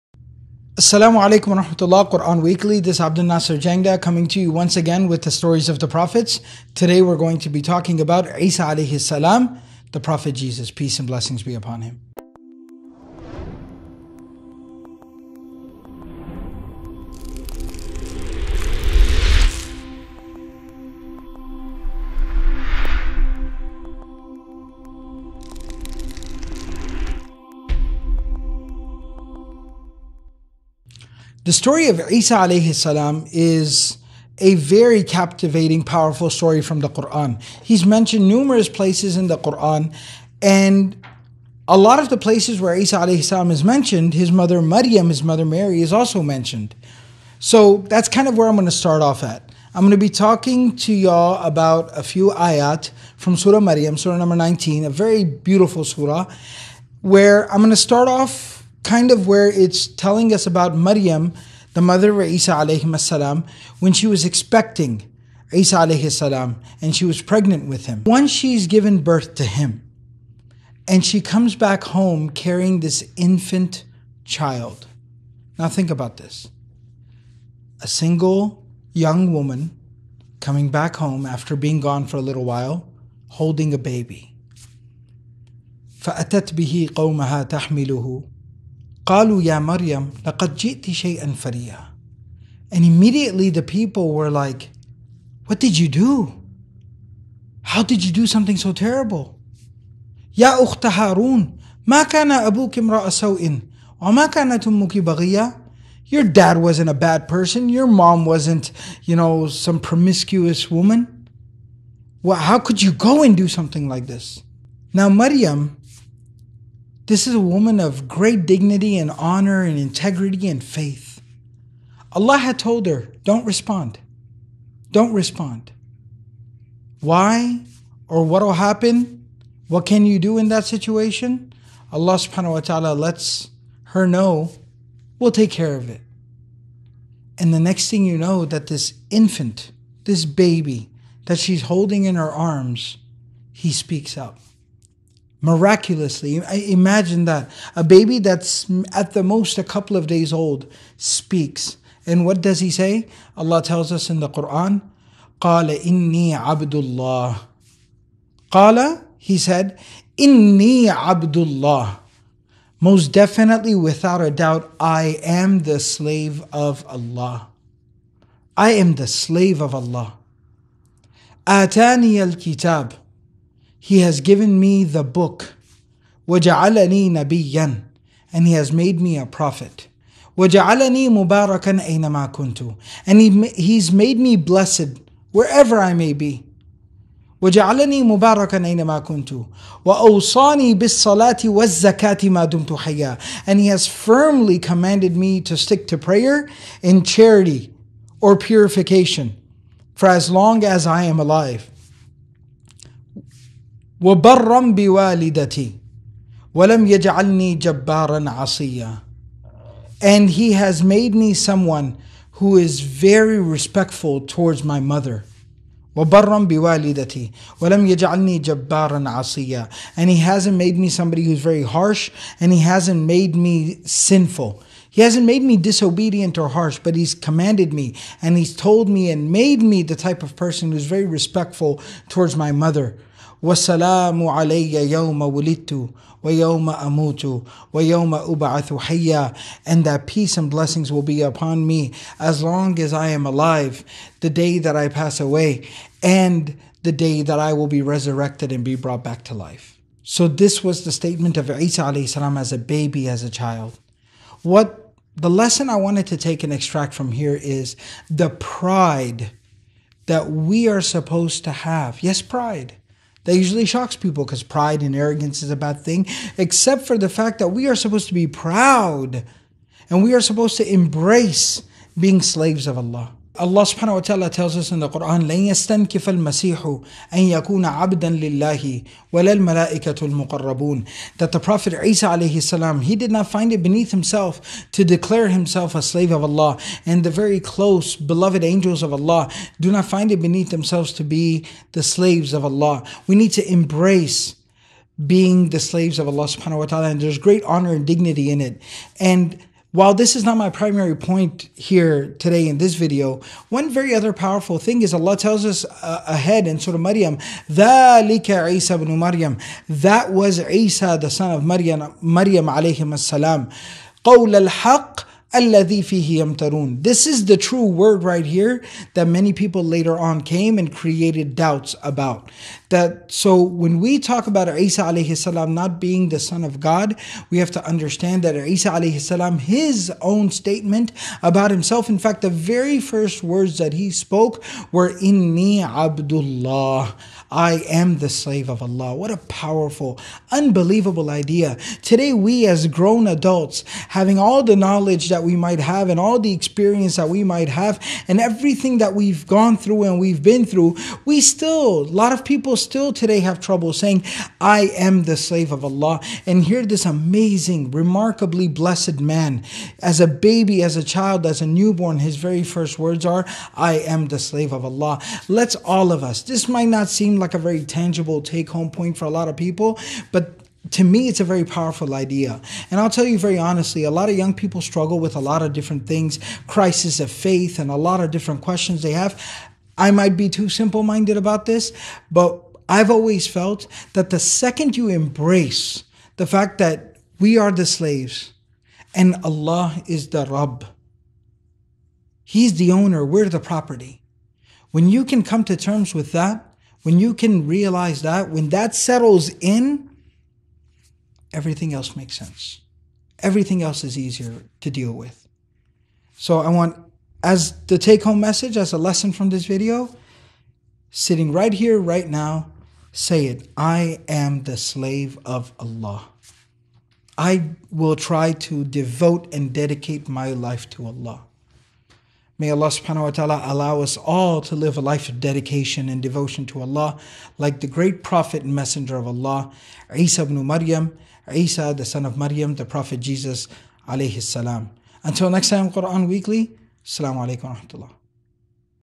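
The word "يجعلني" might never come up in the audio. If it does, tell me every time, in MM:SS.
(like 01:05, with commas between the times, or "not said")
03:26, 03:37.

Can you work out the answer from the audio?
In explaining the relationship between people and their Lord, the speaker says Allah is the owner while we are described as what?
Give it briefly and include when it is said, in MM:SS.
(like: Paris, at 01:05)
the property, at 06:33.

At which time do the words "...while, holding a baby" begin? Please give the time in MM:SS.
01:22.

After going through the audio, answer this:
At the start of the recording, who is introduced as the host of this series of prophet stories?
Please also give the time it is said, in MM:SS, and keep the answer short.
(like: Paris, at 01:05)
Abdul Nasir Jangda, at 00:03.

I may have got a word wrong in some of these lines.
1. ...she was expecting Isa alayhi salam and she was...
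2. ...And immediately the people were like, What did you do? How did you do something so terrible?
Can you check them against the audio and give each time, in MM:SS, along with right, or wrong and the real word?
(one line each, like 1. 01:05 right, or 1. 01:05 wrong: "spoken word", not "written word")
1. 01:03 right
2. 01:32 right.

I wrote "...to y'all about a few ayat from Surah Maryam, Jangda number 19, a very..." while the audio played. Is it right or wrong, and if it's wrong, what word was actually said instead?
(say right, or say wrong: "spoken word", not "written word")
wrong: "Surah", not "Jangda".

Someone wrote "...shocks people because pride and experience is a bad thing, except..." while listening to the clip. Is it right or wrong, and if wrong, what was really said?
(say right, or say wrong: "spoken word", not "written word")
wrong: "arrogance", not "experience".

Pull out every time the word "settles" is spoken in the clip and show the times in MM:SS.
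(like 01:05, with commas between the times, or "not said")
06:38.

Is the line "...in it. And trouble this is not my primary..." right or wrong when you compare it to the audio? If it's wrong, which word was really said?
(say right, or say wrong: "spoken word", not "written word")
wrong: "while", not "trouble".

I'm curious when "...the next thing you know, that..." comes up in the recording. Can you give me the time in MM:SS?
02:17.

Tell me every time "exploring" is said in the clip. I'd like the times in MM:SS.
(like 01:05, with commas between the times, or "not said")
not said.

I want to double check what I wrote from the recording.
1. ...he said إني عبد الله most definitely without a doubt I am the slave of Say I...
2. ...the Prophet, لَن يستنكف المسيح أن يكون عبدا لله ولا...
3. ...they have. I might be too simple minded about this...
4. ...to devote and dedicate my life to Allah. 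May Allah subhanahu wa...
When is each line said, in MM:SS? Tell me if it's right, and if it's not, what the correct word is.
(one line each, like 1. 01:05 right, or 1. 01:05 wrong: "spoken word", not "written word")
1. 02:39 wrong: "Allah", not "Say"
2. 04:34 wrong: "Quran", not "Prophet"
3. 06:18 right
4. 06:58 right.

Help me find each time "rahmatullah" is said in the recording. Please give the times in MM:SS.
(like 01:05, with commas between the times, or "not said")
00:01, 07:17.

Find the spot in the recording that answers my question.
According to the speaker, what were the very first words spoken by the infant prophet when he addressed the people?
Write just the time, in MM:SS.
05:35.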